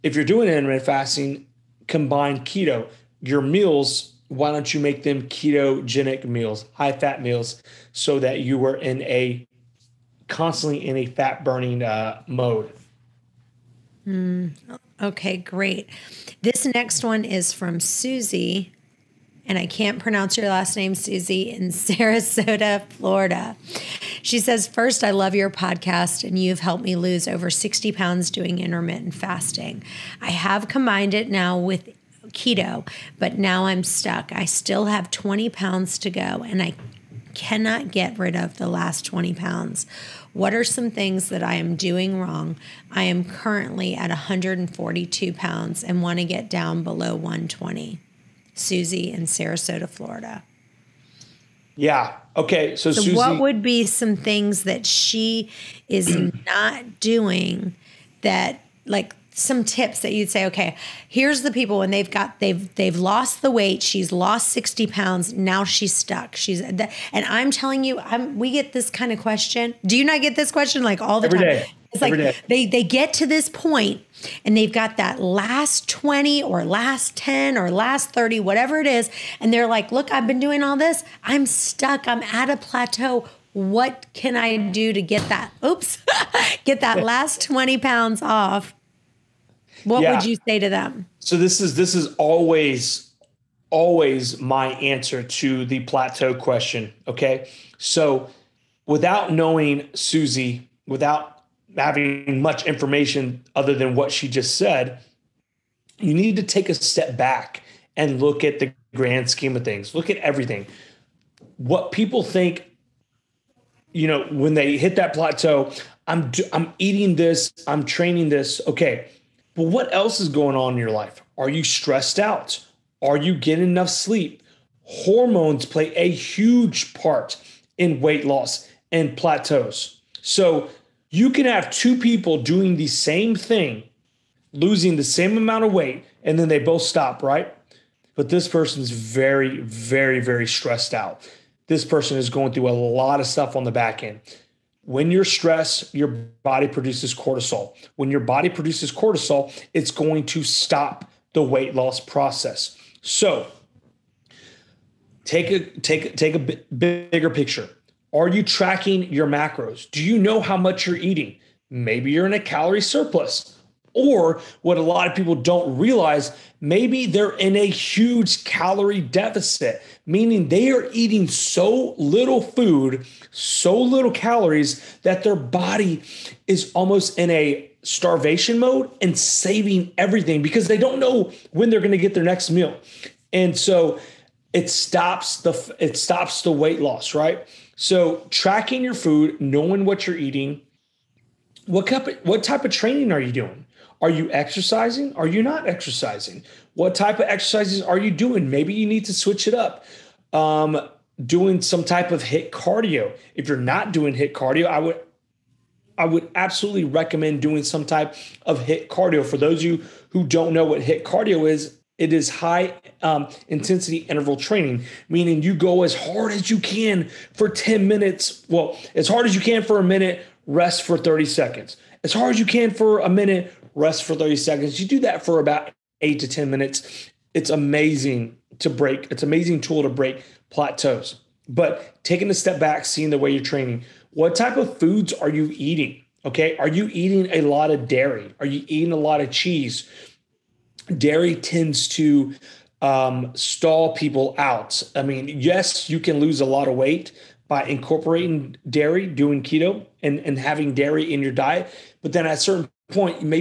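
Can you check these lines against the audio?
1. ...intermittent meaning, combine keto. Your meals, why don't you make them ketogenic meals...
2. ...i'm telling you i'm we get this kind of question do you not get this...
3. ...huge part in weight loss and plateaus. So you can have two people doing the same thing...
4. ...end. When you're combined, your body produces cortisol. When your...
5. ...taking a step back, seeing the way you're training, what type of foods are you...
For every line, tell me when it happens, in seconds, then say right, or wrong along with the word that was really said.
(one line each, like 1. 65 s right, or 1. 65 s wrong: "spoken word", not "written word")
1. 0 s wrong: "fasting", not "meaning"
2. 67 s right
3. 126 s right
4. 144 s wrong: "stressed", not "combined"
5. 232 s right.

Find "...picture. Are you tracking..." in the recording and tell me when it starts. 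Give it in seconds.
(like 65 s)
157 s.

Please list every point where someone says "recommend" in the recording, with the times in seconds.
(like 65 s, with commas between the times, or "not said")
206 s.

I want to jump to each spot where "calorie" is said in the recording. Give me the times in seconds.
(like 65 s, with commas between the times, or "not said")
162 s, 168 s, 174 s.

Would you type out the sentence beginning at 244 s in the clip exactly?
I mean, yes, you can lose a lot of weight by incorporating dairy, doing keto, and, and having dairy in your diet.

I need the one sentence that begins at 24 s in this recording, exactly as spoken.
She says, First, I love your podcast, and you've helped me lose over 60 pounds doing intermittent fasting.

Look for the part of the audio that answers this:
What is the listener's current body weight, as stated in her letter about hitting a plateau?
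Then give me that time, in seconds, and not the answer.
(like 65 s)
44 s.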